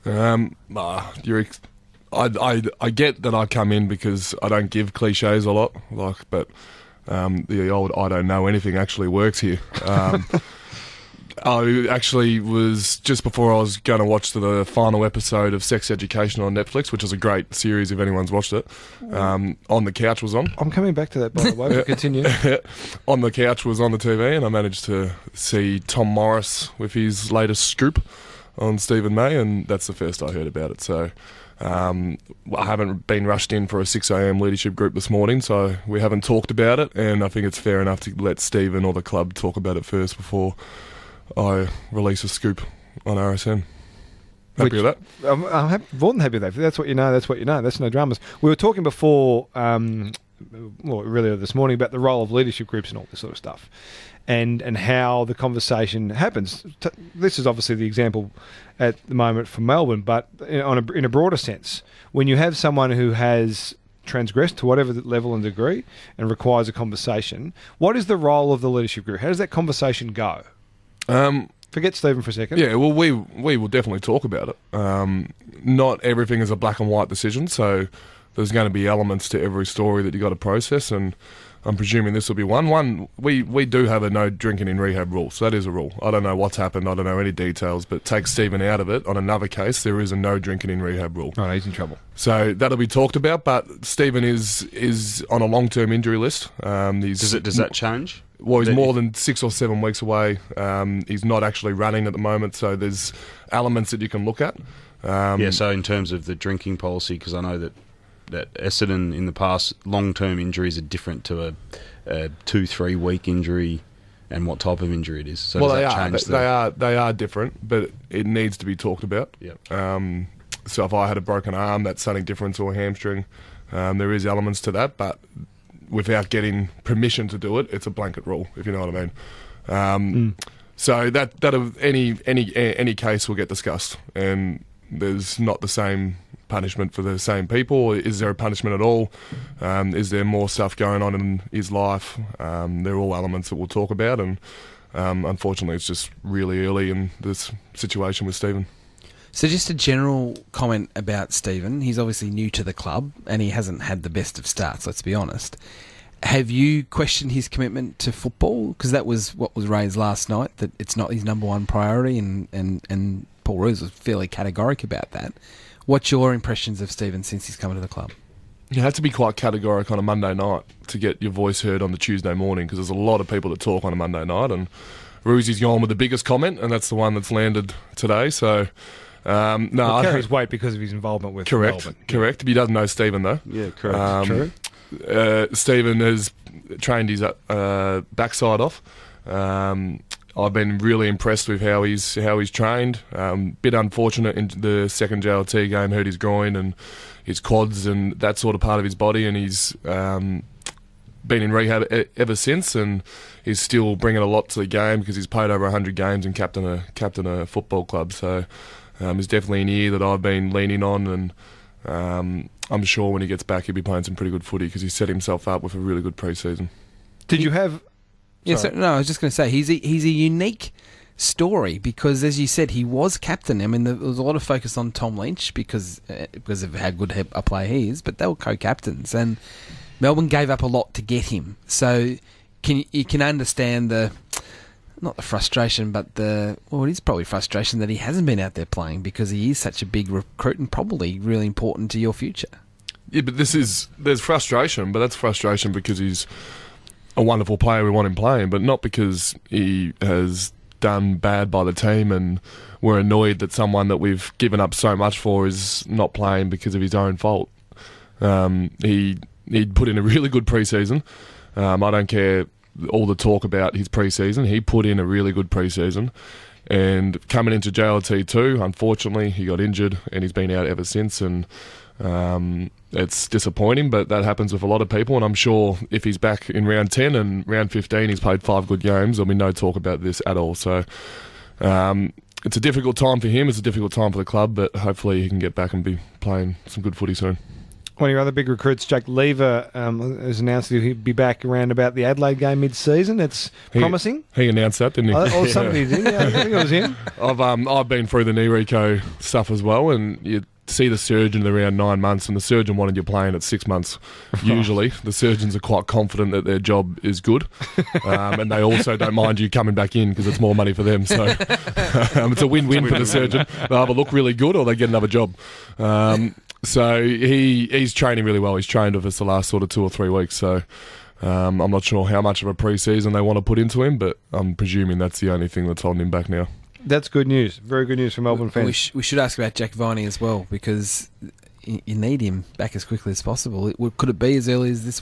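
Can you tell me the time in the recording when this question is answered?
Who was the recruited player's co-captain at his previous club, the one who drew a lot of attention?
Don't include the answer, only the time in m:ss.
3:44.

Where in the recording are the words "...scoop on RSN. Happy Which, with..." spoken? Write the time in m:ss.
0:42.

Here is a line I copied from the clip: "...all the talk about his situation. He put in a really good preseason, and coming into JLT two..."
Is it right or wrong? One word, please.
wrong.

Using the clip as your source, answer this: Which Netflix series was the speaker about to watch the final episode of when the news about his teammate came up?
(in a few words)
Sex Education.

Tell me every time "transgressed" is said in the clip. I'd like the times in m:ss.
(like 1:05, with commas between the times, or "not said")
1:04.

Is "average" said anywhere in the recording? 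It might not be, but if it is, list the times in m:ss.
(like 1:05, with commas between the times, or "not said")
not said.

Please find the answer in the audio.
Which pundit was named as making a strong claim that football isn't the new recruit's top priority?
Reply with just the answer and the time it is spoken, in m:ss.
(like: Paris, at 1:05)
Paul Roos, at 2:43.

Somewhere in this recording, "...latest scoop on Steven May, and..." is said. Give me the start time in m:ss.
0:27.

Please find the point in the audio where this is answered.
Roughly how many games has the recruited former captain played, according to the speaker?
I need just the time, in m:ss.
3:25.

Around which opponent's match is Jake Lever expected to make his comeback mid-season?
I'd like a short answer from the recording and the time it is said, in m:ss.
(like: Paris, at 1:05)
Adelaide, at 4:52.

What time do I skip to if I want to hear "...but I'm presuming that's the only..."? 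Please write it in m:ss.
5:23.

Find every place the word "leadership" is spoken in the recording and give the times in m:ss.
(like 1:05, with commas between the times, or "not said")
0:34, 0:52, 1:08.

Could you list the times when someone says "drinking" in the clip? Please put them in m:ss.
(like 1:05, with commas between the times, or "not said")
1:24, 1:30, 1:46.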